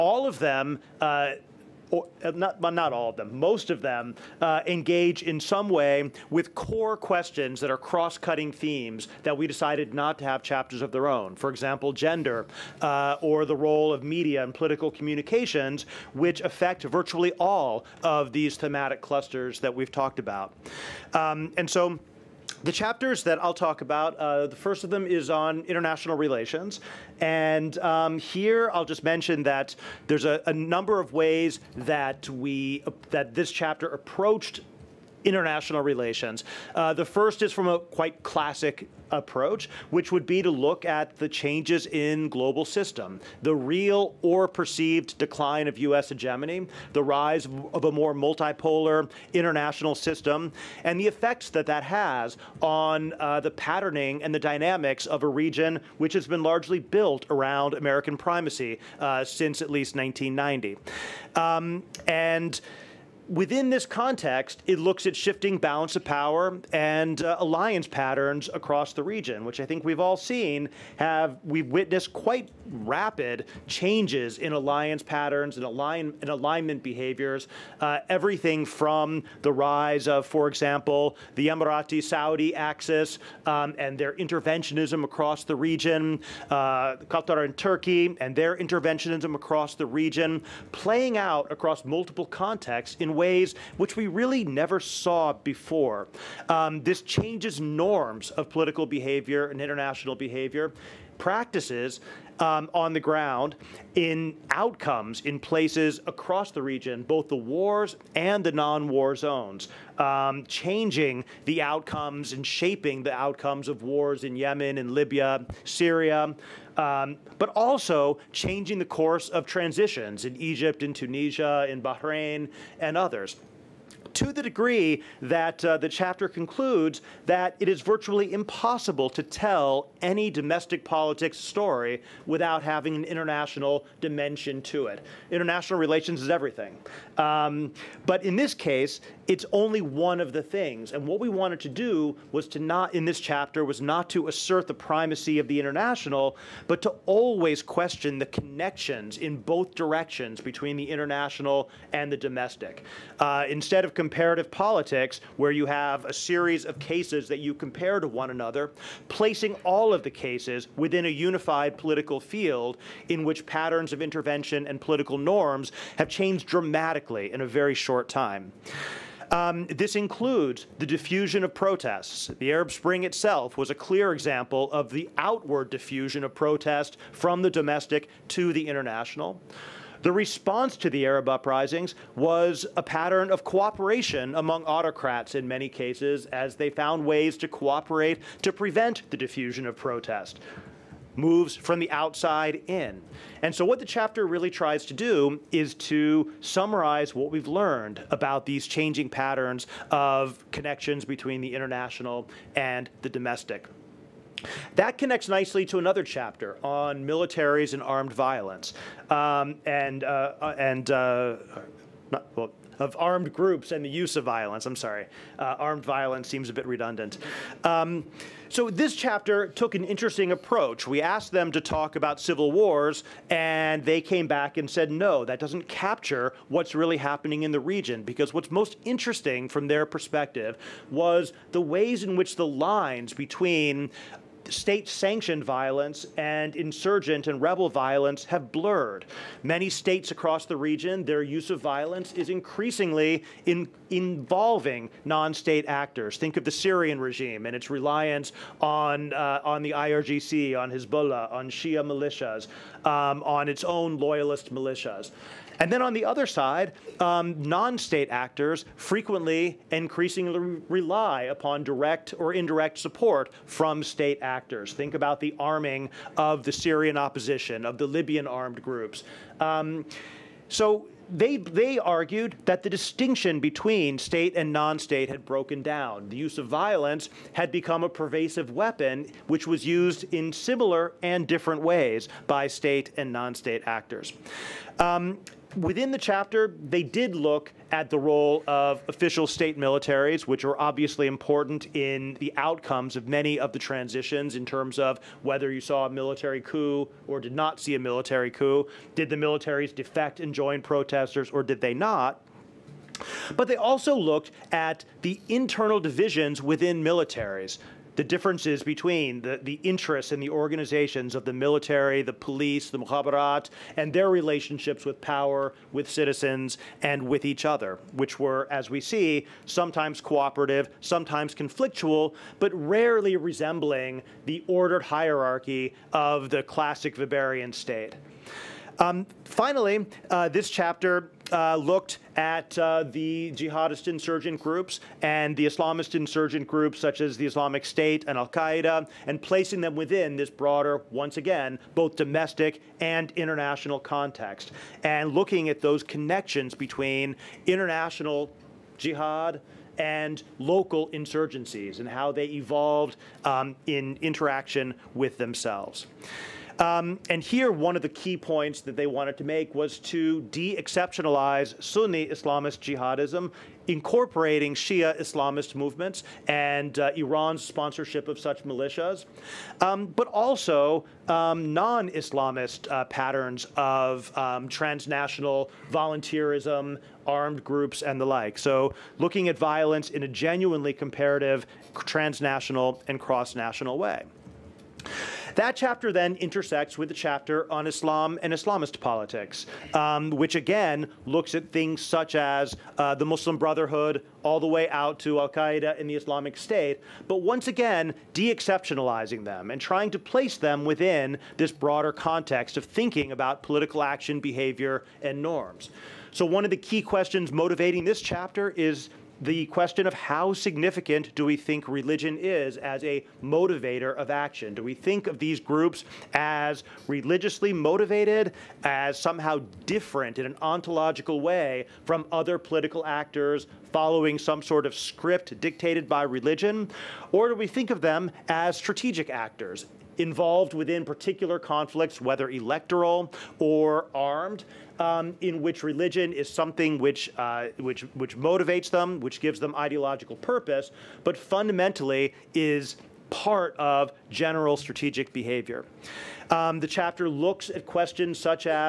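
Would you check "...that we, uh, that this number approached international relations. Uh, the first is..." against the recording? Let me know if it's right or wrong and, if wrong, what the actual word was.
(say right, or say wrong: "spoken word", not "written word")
wrong: "chapter", not "number".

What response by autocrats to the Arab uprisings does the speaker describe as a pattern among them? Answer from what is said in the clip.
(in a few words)
Cooperation.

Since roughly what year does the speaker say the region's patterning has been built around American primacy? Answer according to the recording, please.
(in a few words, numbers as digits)
1990.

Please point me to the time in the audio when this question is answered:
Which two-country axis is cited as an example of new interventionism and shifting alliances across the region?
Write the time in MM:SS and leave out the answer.
01:21.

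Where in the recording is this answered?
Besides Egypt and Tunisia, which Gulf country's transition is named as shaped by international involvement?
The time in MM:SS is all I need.
02:01.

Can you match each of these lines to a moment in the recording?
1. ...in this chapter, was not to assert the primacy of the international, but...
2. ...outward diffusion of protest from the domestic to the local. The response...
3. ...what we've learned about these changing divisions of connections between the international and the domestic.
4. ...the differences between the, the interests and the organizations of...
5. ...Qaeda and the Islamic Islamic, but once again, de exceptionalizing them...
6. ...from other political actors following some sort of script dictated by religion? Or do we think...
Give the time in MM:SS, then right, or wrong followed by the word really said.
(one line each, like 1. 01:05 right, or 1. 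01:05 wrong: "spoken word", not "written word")
1. 02:22 right
2. 02:55 wrong: "international", not "local"
3. 03:17 wrong: "patterns", not "divisions"
4. 05:07 right
5. 06:35 wrong: "State", not "Islamic"
6. 07:01 right.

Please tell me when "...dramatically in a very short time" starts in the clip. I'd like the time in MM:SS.
02:46.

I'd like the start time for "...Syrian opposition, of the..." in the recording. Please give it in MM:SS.
04:26.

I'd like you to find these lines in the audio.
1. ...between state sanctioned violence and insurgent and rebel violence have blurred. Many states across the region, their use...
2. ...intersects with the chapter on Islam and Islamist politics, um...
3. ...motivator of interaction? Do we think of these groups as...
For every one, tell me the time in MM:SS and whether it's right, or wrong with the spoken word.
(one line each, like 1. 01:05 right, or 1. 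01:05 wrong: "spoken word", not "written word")
1. 03:53 right
2. 06:26 right
3. 06:53 wrong: "action", not "interaction".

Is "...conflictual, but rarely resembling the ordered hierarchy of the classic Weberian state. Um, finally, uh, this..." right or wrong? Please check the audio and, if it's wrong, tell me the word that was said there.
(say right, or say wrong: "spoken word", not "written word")
right.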